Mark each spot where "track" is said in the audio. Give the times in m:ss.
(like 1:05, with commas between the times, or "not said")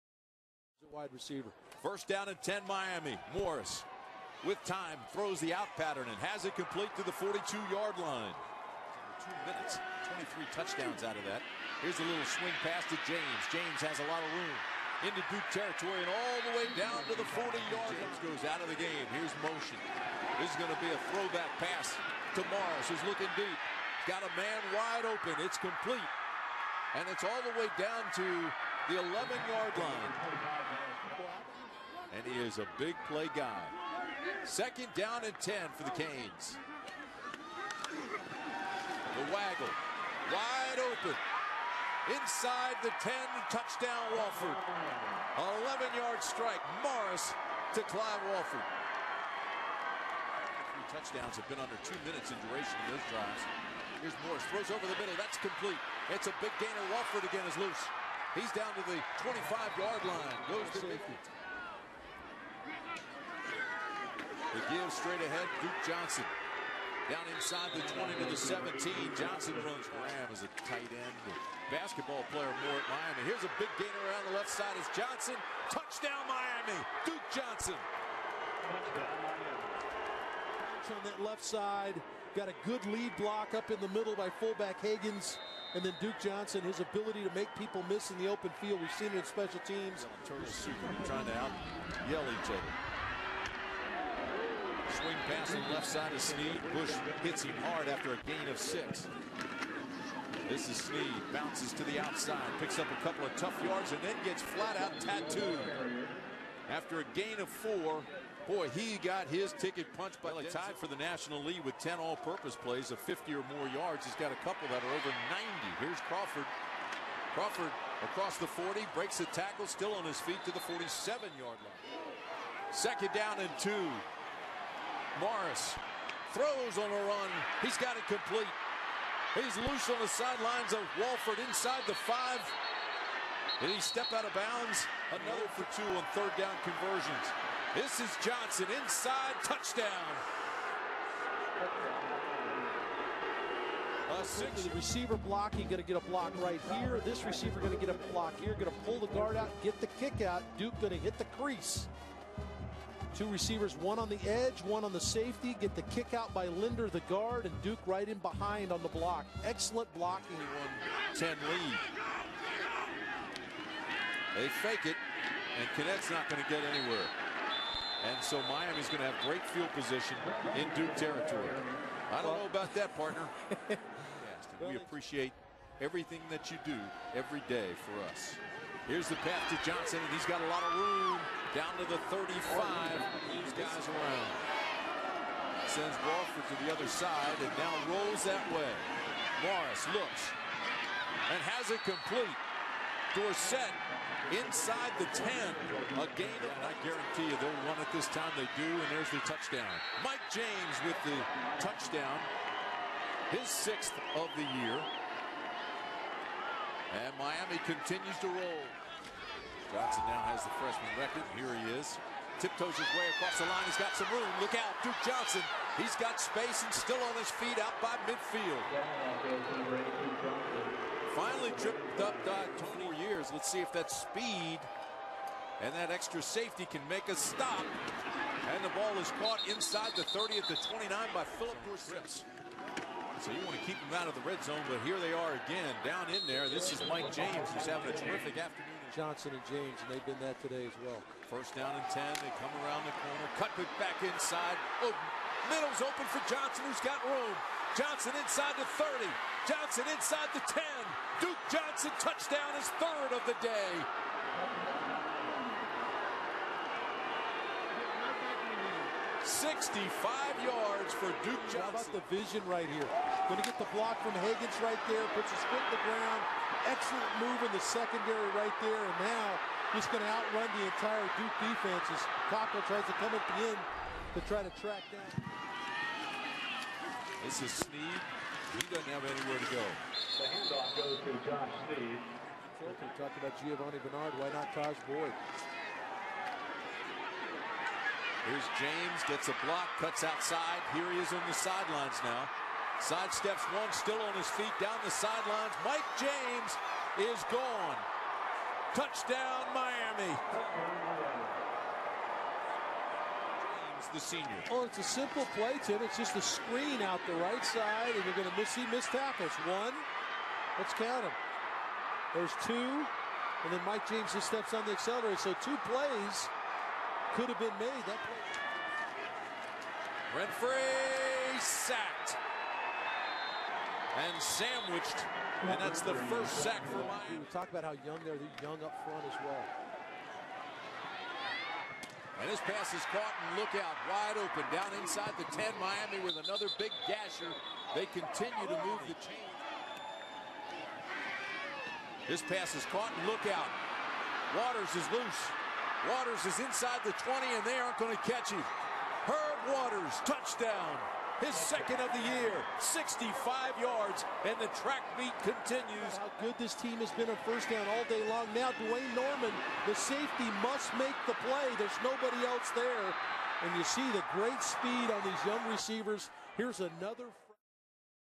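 4:34, 5:54.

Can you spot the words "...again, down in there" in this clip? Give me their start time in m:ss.
3:55.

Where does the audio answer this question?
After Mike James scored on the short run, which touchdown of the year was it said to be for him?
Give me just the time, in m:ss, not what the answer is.
3:23.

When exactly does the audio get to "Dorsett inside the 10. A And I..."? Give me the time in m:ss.
3:13.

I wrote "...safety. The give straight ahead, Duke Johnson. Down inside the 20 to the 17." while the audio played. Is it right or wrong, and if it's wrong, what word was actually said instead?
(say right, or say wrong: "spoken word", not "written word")
right.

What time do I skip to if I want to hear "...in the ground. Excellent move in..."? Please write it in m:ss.
4:25.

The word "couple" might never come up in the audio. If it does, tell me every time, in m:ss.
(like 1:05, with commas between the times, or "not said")
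1:43, 1:54.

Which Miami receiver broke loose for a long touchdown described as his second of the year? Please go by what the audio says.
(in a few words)
Herb Waters.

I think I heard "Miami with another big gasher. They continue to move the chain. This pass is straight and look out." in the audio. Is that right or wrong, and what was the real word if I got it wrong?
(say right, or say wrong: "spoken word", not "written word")
wrong: "caught", not "straight".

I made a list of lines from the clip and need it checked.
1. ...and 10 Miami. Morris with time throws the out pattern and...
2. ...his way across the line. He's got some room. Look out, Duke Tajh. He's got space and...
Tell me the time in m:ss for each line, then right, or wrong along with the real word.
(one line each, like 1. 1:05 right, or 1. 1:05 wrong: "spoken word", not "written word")
1. 0:02 right
2. 3:32 wrong: "Johnson", not "Tajh".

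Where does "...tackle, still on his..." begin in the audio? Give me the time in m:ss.
1:59.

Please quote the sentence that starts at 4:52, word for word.
Sidesteps one, still on his feet, down the sidelines.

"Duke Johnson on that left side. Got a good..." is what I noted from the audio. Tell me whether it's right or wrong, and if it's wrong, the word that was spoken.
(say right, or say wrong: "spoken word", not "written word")
right.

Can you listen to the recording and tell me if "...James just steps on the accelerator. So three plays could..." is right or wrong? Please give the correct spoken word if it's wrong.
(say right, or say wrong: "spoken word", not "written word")
wrong: "two", not "three".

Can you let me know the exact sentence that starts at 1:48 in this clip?
Boy, he got his ticket punched by tied for the national lead with 10 all-purpose plays of 50 or more yards.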